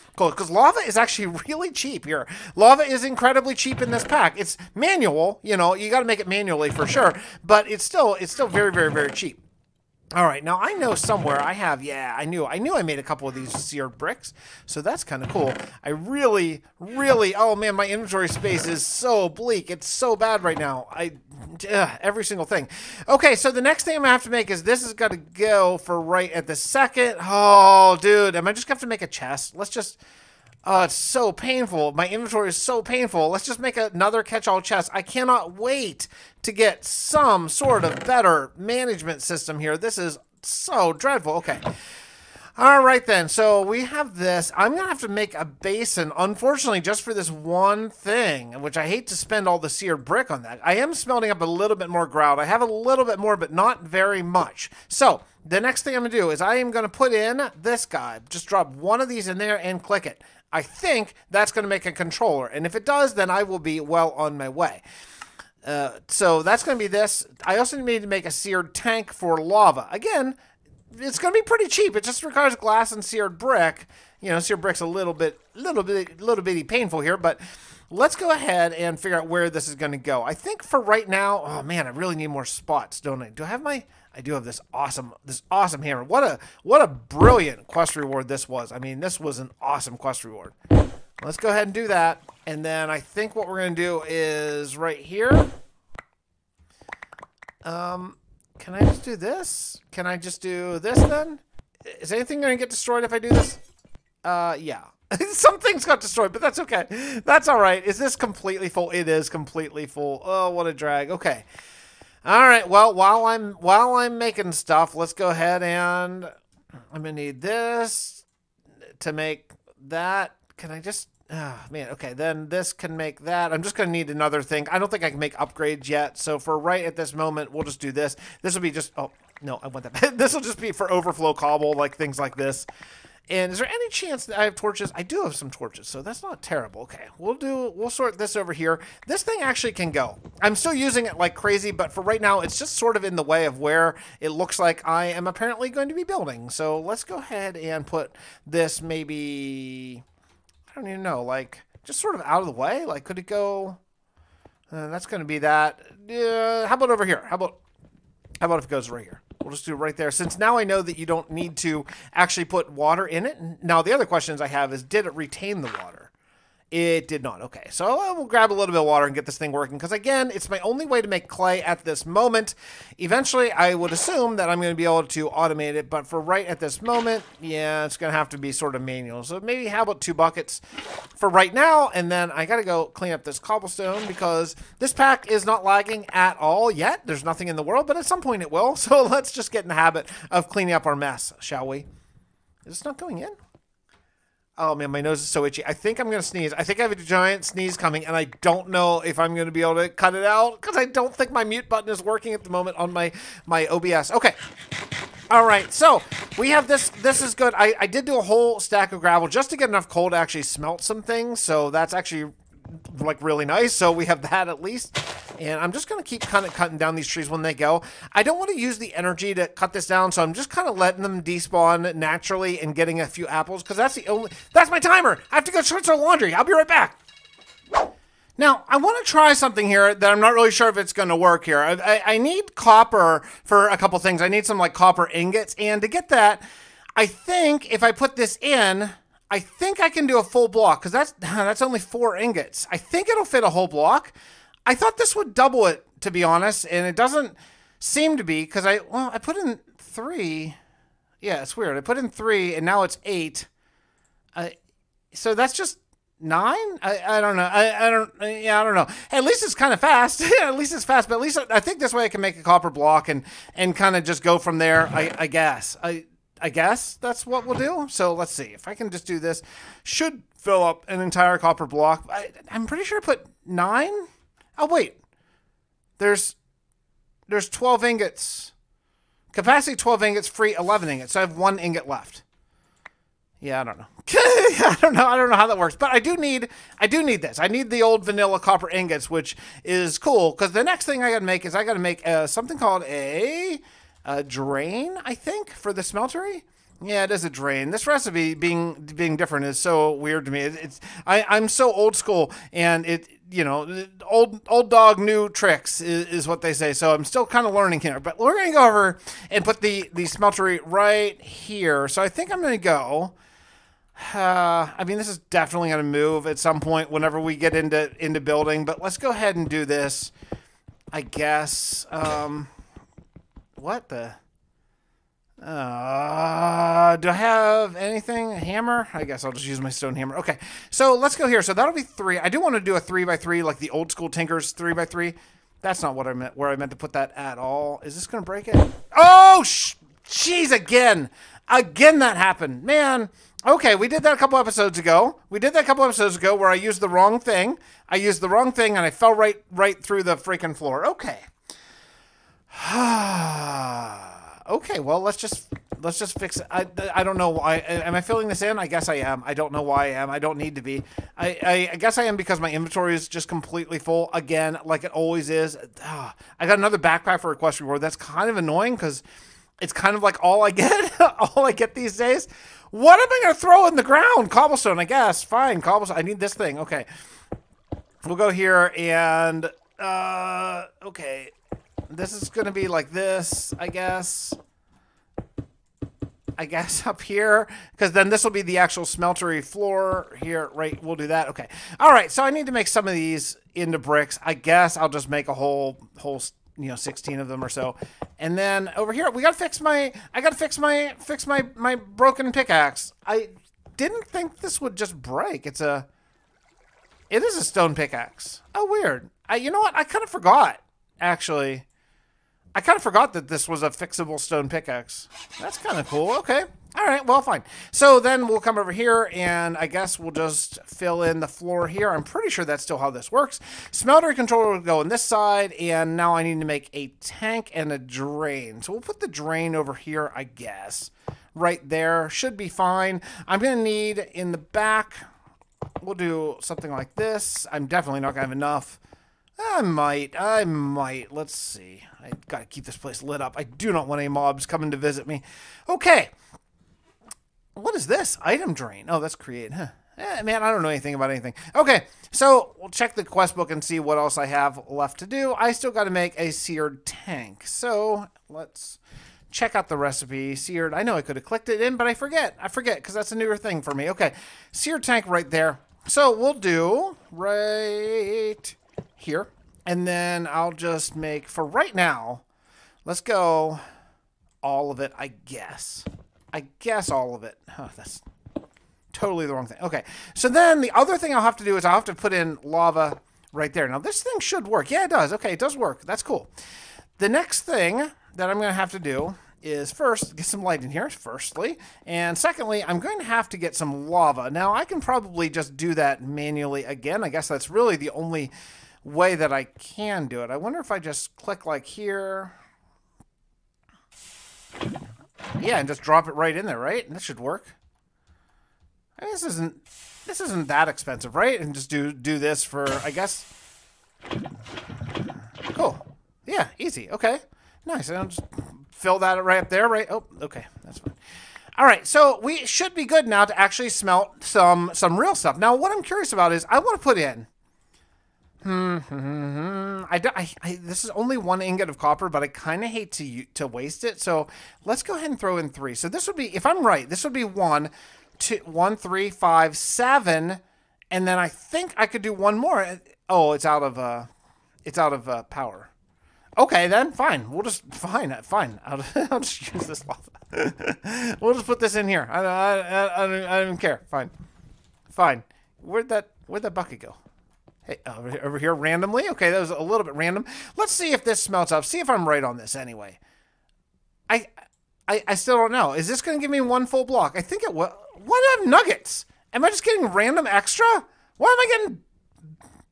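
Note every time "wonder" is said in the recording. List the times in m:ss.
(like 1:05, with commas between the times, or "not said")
8:20.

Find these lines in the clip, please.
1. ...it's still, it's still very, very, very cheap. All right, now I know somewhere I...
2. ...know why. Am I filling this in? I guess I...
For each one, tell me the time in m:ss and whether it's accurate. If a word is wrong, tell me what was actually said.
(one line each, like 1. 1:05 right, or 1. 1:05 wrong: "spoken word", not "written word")
1. 0:07 right
2. 5:57 right.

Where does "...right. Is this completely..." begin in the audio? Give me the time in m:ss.
1:47.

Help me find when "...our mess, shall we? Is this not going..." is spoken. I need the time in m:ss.
3:10.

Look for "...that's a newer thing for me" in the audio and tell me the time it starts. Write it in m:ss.
7:42.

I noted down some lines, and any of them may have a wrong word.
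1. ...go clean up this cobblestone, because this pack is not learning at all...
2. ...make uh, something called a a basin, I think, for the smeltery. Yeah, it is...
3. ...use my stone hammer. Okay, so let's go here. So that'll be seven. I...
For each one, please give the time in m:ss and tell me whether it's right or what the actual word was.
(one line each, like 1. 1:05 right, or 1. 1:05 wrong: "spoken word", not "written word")
1. 3:02 wrong: "lagging", not "learning"
2. 4:51 wrong: "drain", not "basin"
3. 5:29 wrong: "three", not "seven".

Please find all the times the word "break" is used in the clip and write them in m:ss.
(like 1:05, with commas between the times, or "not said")
5:38, 6:45.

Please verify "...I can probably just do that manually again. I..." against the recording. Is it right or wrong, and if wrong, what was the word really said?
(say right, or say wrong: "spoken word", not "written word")
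right.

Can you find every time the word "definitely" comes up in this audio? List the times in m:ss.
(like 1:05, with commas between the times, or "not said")
5:15, 7:17.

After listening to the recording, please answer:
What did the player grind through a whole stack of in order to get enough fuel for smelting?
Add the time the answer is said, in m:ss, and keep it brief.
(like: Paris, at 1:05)
Gravel, at 3:28.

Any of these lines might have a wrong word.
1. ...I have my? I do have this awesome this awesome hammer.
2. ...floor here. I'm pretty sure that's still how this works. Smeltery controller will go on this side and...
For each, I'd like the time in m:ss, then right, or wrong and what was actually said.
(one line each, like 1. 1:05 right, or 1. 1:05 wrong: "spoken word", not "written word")
1. 1:23 right
2. 7:01 right.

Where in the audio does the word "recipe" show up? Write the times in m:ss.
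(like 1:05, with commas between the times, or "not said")
4:57, 7:39.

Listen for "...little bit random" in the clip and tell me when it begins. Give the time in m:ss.
9:19.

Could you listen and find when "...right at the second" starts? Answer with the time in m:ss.
0:26.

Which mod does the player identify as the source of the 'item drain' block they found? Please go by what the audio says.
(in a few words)
Create.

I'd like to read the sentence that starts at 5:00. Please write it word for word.
It, it's I I'm so old school, and it you know old old dog new tricks is, is what they say.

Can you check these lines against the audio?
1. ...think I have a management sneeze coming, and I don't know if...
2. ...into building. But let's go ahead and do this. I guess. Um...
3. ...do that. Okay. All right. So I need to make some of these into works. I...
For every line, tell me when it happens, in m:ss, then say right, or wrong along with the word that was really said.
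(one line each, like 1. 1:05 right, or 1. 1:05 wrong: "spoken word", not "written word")
1. 3:16 wrong: "giant", not "management"
2. 5:18 right
3. 6:30 wrong: "bricks", not "works".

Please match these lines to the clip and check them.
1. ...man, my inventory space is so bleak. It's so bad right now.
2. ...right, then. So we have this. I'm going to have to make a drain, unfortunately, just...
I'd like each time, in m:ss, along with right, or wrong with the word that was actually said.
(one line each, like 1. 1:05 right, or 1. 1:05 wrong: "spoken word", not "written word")
1. 0:17 right
2. 0:42 wrong: "basin", not "drain".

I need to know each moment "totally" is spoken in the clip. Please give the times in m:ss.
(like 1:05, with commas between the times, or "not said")
7:58.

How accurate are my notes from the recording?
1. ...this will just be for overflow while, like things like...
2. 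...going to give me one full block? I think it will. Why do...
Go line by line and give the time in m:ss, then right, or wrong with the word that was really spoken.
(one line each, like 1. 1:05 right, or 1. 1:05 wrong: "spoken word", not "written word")
1. 2:10 wrong: "cobble", not "while"
2. 9:26 right.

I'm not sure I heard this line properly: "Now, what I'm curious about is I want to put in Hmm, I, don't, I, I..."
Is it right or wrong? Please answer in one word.
right.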